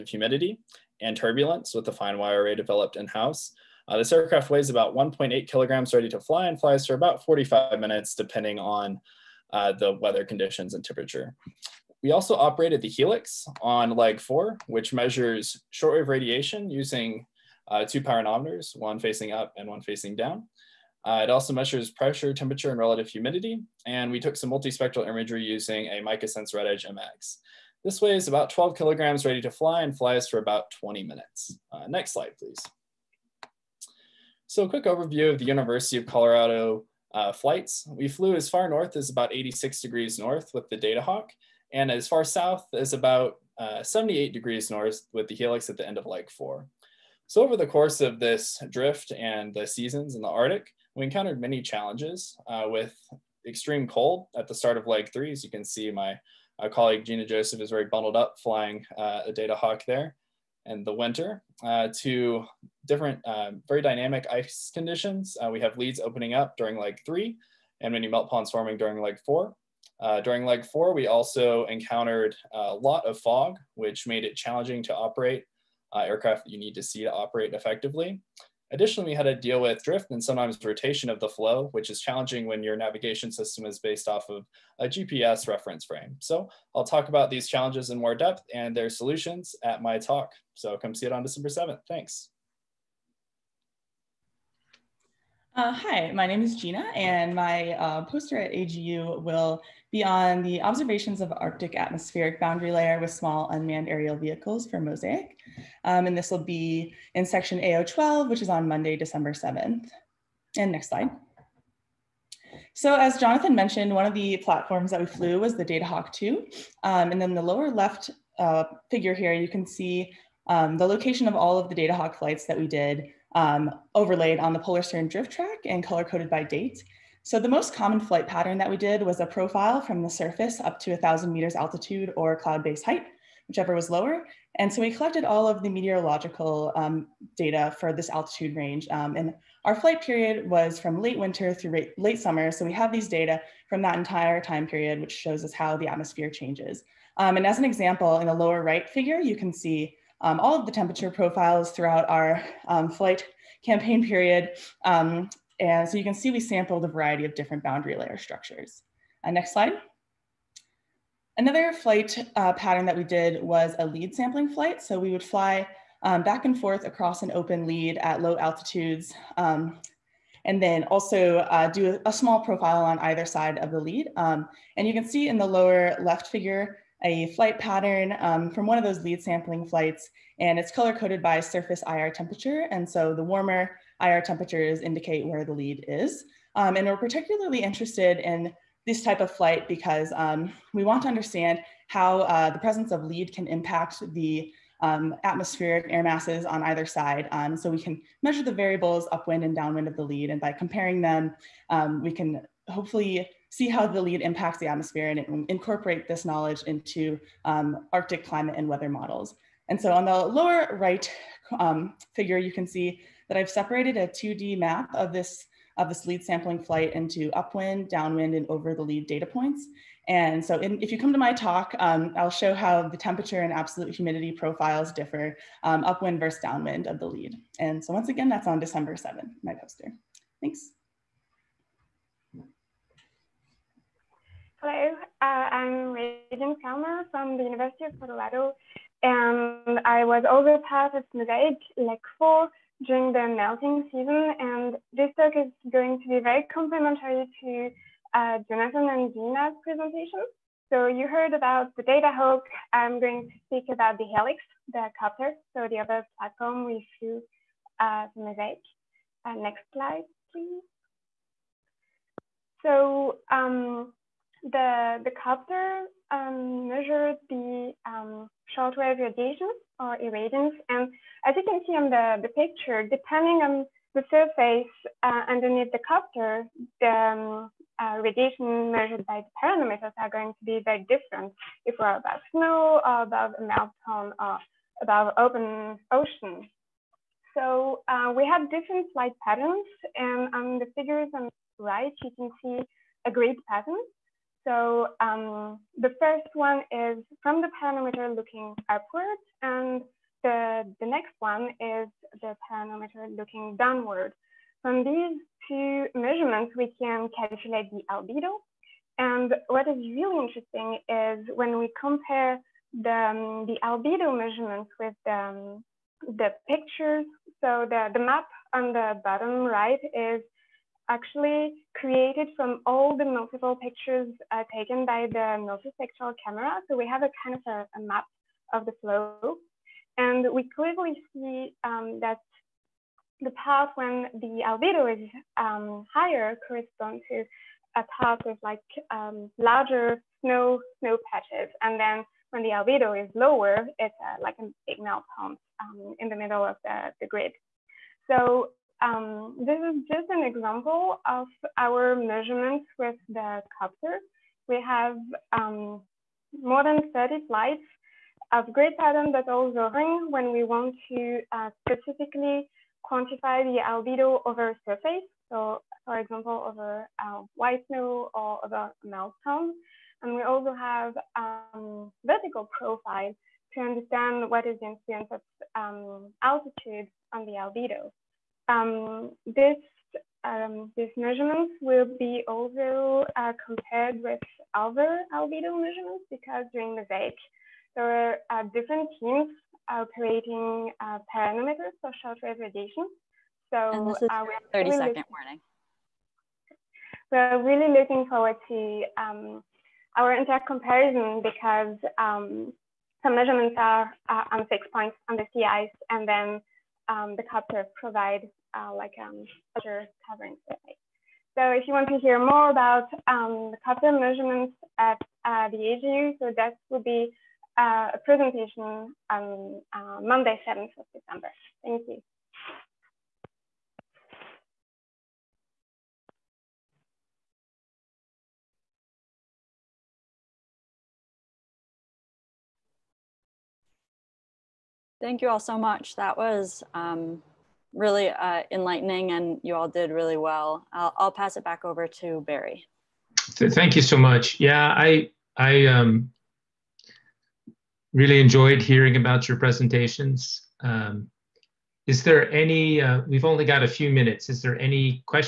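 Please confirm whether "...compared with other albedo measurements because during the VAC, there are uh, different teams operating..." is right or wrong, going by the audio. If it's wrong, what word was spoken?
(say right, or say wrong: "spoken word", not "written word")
right.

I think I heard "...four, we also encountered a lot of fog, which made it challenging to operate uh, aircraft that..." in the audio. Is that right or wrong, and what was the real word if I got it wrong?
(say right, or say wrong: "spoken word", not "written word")
right.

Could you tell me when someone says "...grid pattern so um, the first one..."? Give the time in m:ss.
4:53.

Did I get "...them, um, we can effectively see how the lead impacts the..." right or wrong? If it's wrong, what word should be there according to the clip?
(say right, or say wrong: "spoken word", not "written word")
wrong: "hopefully", not "effectively".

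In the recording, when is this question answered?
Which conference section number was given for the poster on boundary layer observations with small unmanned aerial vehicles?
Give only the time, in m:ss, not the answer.
1:47.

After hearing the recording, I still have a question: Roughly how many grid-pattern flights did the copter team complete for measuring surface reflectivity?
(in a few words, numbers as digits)
more than 30.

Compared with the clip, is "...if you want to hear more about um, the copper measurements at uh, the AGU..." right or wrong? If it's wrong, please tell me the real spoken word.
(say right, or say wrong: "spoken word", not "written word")
right.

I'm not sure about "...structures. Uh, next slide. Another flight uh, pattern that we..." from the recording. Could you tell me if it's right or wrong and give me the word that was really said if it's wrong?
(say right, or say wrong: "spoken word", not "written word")
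right.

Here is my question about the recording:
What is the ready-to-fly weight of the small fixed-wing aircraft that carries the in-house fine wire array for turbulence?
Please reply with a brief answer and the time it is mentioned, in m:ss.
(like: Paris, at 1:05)
1.8 kilograms, at 0:04.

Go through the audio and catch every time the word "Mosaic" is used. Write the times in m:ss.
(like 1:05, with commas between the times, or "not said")
1:44, 4:01, 4:18.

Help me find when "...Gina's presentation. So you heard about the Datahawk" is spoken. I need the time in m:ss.
4:09.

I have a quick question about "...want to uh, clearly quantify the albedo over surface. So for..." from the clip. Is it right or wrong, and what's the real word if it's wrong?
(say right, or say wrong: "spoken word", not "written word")
wrong: "specifically", not "clearly".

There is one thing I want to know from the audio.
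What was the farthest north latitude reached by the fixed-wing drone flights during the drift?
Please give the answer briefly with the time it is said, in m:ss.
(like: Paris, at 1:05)
86 degrees north, at 0:39.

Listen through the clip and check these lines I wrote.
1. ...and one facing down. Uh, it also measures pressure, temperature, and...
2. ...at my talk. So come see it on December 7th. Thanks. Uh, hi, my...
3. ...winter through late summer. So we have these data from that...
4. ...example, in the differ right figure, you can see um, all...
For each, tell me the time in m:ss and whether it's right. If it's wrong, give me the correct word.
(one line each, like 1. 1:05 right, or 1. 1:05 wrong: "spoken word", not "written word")
1. 0:19 right
2. 1:29 right
3. 2:21 right
4. 2:27 wrong: "lower", not "differ".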